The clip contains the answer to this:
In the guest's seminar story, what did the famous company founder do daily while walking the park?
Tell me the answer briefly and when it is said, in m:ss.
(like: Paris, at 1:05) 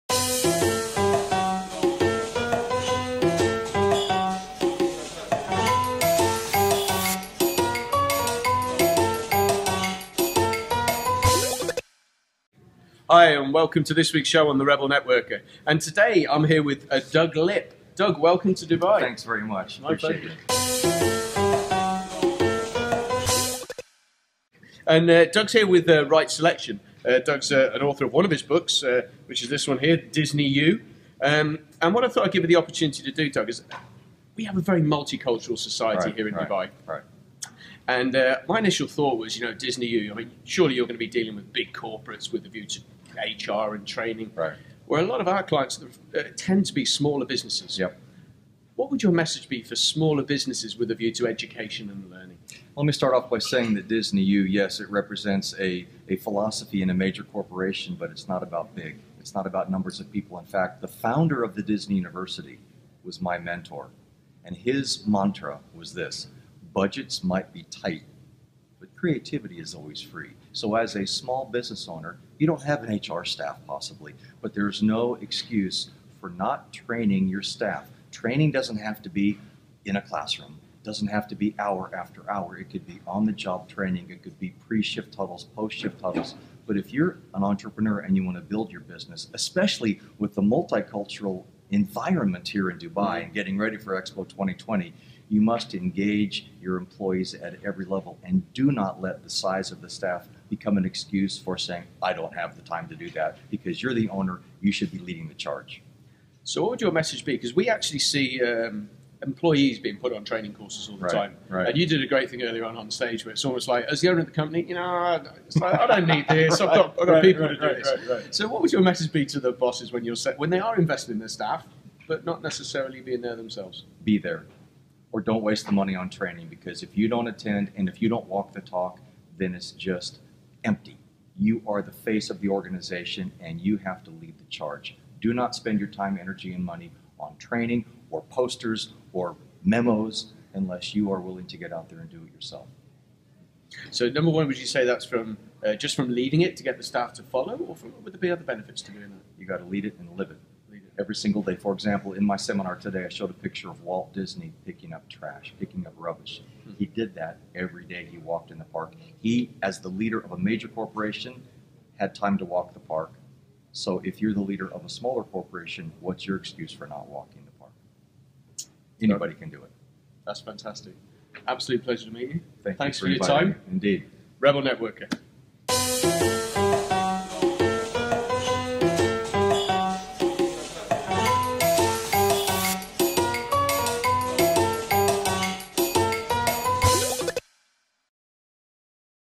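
picking up trash, at 2:34.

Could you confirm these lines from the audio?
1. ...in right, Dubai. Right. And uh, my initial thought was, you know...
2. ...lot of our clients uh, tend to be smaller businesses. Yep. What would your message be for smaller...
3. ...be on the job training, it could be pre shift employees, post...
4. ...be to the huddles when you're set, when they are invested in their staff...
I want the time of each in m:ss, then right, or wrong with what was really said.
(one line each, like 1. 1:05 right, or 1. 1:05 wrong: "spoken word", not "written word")
1. 0:36 right
2. 0:45 right
3. 1:22 wrong: "huddles", not "employees"
4. 1:59 wrong: "bosses", not "huddles".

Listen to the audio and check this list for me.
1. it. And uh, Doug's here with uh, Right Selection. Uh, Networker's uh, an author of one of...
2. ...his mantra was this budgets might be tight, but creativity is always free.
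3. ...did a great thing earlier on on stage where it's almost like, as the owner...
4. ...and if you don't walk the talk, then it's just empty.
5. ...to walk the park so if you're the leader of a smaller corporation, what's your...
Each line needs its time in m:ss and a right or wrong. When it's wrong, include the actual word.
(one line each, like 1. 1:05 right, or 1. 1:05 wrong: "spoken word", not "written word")
1. 0:23 wrong: "Doug", not "Networker"
2. 1:04 right
3. 1:51 right
4. 2:07 right
5. 2:42 right.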